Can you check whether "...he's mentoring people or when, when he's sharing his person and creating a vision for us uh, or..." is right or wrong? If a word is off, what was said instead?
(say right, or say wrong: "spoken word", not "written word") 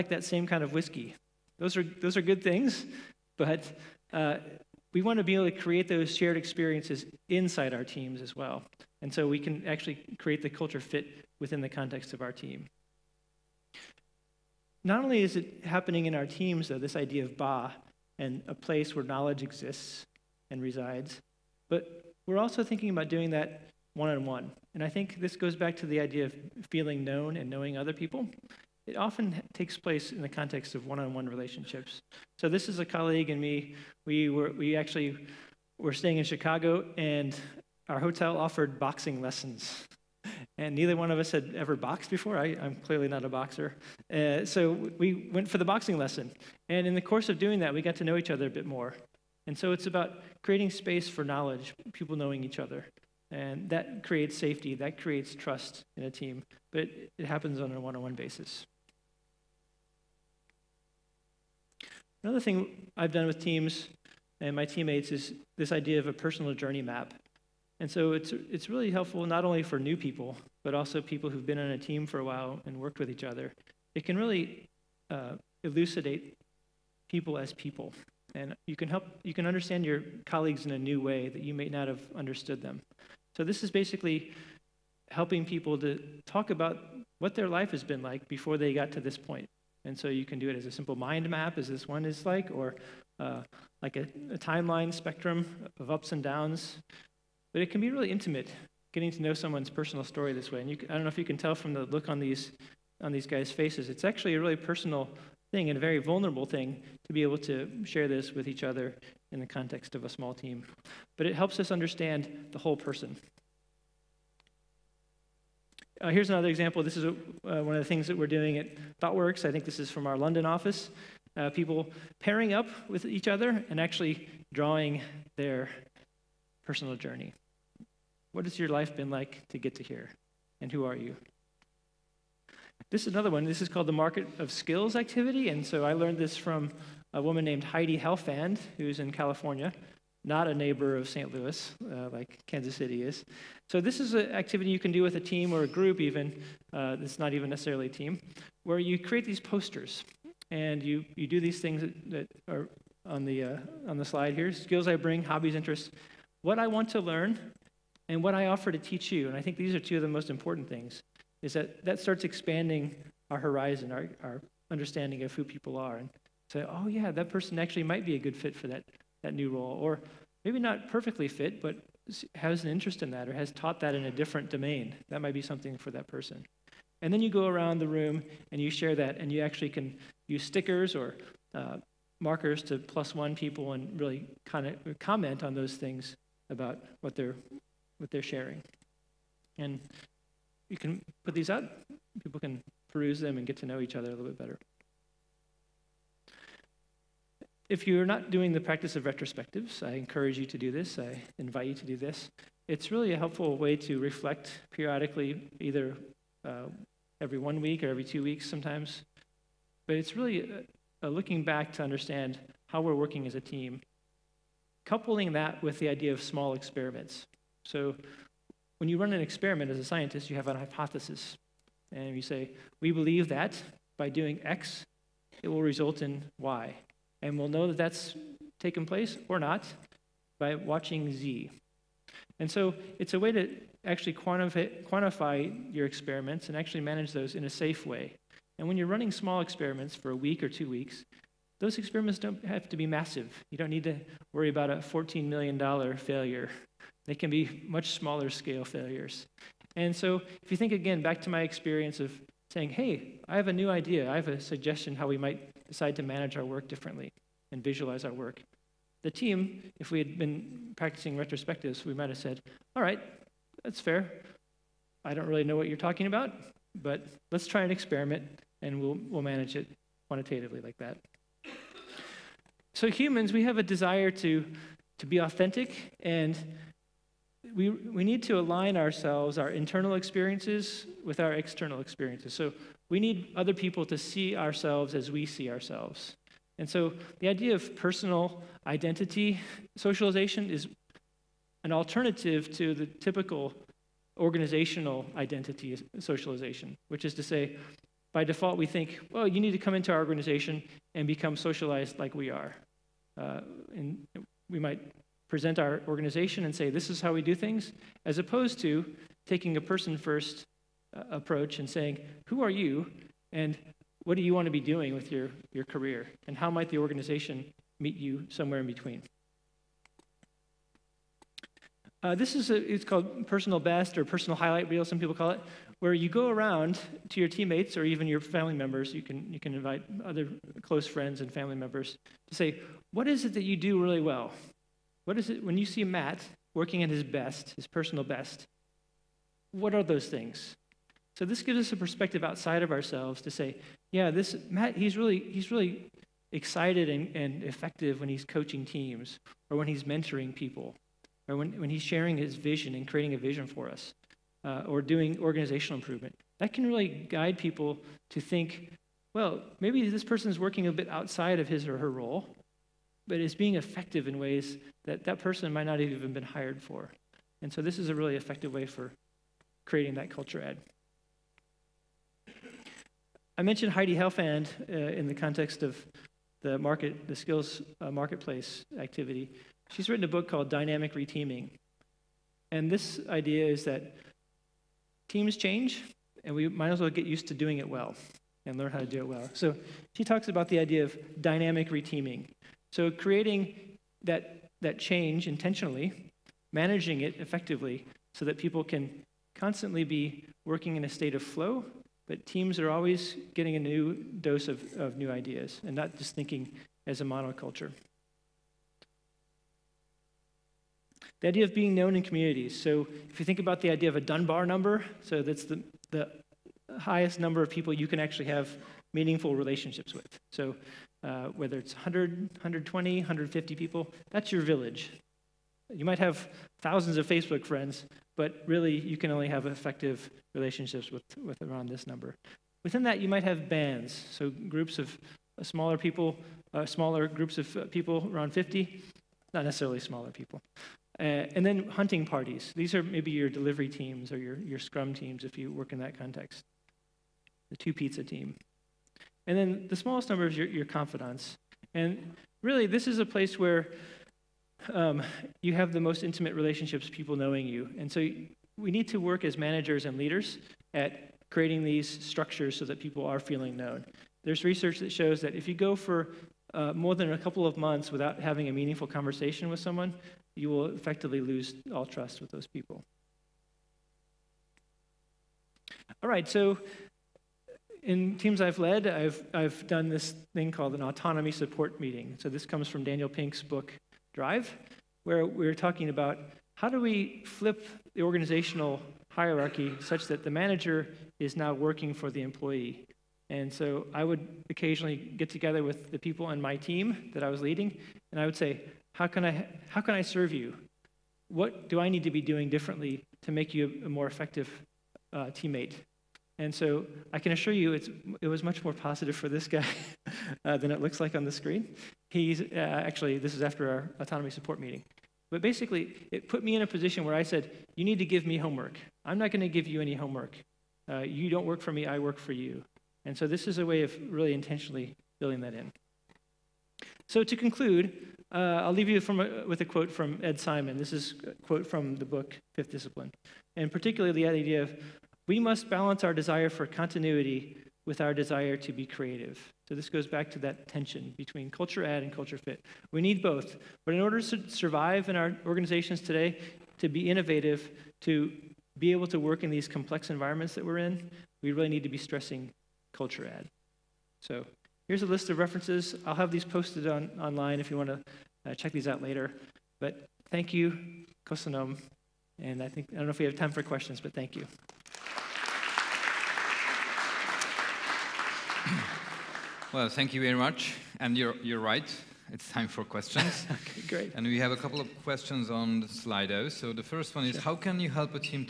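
wrong: "vision", not "person".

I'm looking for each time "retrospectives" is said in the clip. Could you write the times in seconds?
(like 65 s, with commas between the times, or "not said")
199 s, 261 s.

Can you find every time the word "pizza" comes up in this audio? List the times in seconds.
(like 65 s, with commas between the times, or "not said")
447 s.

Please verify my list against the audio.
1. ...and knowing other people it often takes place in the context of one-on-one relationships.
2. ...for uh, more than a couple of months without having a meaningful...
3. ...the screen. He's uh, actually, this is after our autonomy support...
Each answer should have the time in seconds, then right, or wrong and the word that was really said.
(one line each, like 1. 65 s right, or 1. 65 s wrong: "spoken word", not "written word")
1. 27 s right
2. 465 s right
3. 511 s right.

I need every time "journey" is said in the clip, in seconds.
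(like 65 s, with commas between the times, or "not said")
66 s, 126 s.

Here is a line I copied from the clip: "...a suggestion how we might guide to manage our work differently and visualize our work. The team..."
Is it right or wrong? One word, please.
wrong.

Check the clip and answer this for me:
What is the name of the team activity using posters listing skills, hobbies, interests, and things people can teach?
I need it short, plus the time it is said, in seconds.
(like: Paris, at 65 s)
Market of Skills, at 133 s.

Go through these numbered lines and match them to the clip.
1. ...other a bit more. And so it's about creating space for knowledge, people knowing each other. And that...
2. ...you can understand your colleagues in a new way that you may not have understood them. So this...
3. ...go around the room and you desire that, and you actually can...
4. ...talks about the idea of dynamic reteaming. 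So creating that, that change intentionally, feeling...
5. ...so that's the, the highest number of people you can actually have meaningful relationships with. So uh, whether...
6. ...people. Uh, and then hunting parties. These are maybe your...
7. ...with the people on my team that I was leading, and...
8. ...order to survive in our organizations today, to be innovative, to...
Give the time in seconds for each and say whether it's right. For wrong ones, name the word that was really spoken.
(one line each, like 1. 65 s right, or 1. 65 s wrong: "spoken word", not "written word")
1. 48 s right
2. 79 s right
3. 177 s wrong: "share", not "desire"
4. 390 s wrong: "managing", not "feeling"
5. 415 s right
6. 440 s right
7. 495 s right
8. 544 s right.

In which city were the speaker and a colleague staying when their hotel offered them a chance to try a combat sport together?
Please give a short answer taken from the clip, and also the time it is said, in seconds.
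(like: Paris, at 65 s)
Chicago, at 36 s.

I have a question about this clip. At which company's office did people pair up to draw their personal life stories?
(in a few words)
ThoughtWorks.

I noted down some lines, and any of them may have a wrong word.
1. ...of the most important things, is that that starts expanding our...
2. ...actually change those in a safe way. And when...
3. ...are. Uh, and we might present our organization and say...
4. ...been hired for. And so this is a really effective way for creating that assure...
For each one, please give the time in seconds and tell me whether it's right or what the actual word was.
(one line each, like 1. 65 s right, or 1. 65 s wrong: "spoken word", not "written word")
1. 159 s right
2. 236 s wrong: "manage", not "change"
3. 302 s right
4. 366 s wrong: "culture", not "assure".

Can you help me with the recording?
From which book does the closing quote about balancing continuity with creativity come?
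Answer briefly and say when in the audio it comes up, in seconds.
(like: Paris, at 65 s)
Fifth Discipline, at 532 s.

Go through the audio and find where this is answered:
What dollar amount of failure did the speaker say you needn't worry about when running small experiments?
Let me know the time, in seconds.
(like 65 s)
244 s.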